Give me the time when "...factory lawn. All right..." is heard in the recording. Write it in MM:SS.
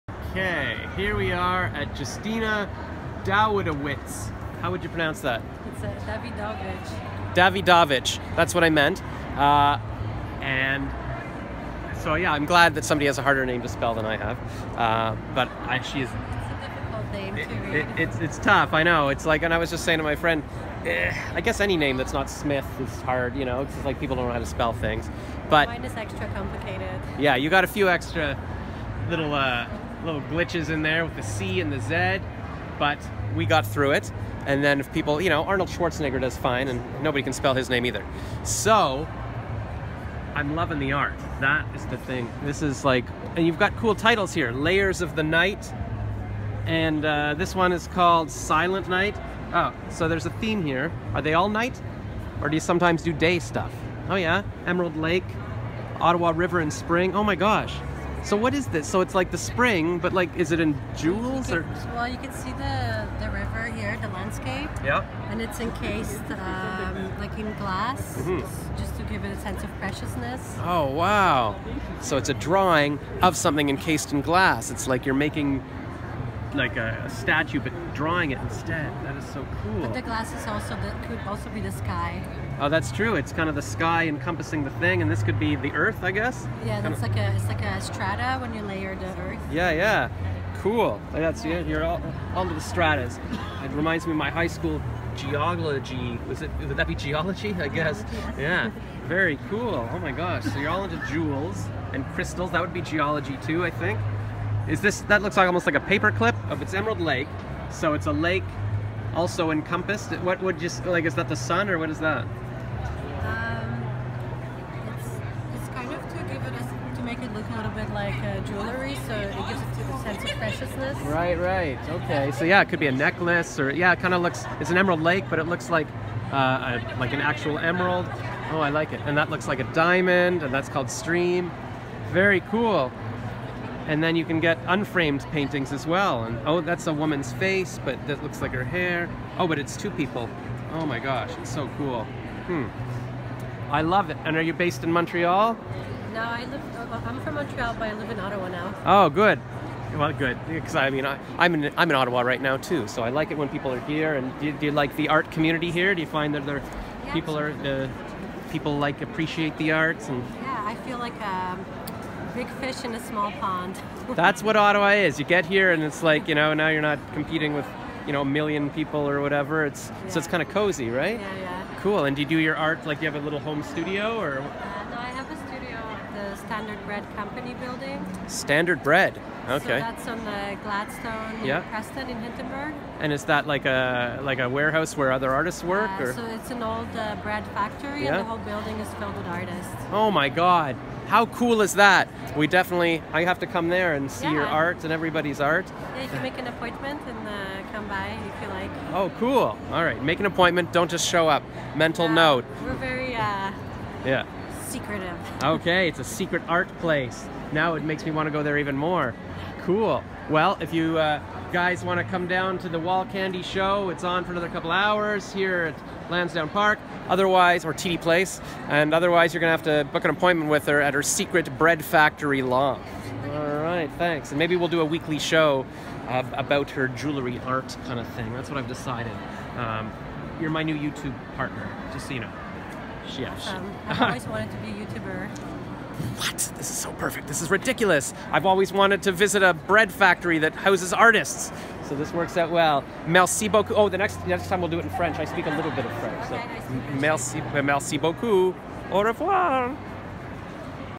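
03:41.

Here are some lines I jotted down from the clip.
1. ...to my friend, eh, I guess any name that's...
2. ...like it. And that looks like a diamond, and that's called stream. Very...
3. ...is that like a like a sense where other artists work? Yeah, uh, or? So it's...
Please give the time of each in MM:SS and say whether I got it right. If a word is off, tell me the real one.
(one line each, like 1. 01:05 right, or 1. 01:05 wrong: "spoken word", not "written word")
1. 00:19 right
2. 02:08 right
3. 03:03 wrong: "warehouse", not "sense".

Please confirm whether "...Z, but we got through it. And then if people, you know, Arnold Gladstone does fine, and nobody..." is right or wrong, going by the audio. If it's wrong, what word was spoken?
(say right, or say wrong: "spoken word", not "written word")
wrong: "Schwarzenegger", not "Gladstone".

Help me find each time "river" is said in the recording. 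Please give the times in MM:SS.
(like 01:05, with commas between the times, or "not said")
00:56, 01:03.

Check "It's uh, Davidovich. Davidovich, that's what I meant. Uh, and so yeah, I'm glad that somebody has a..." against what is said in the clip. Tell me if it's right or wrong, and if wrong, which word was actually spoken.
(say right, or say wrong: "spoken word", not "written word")
right.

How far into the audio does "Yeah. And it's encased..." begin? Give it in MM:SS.
01:04.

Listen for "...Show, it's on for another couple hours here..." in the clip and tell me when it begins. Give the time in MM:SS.
03:33.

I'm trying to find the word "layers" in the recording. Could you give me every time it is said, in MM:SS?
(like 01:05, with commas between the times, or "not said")
00:44, 01:28.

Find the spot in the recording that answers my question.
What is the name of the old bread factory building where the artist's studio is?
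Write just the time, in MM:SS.
02:56.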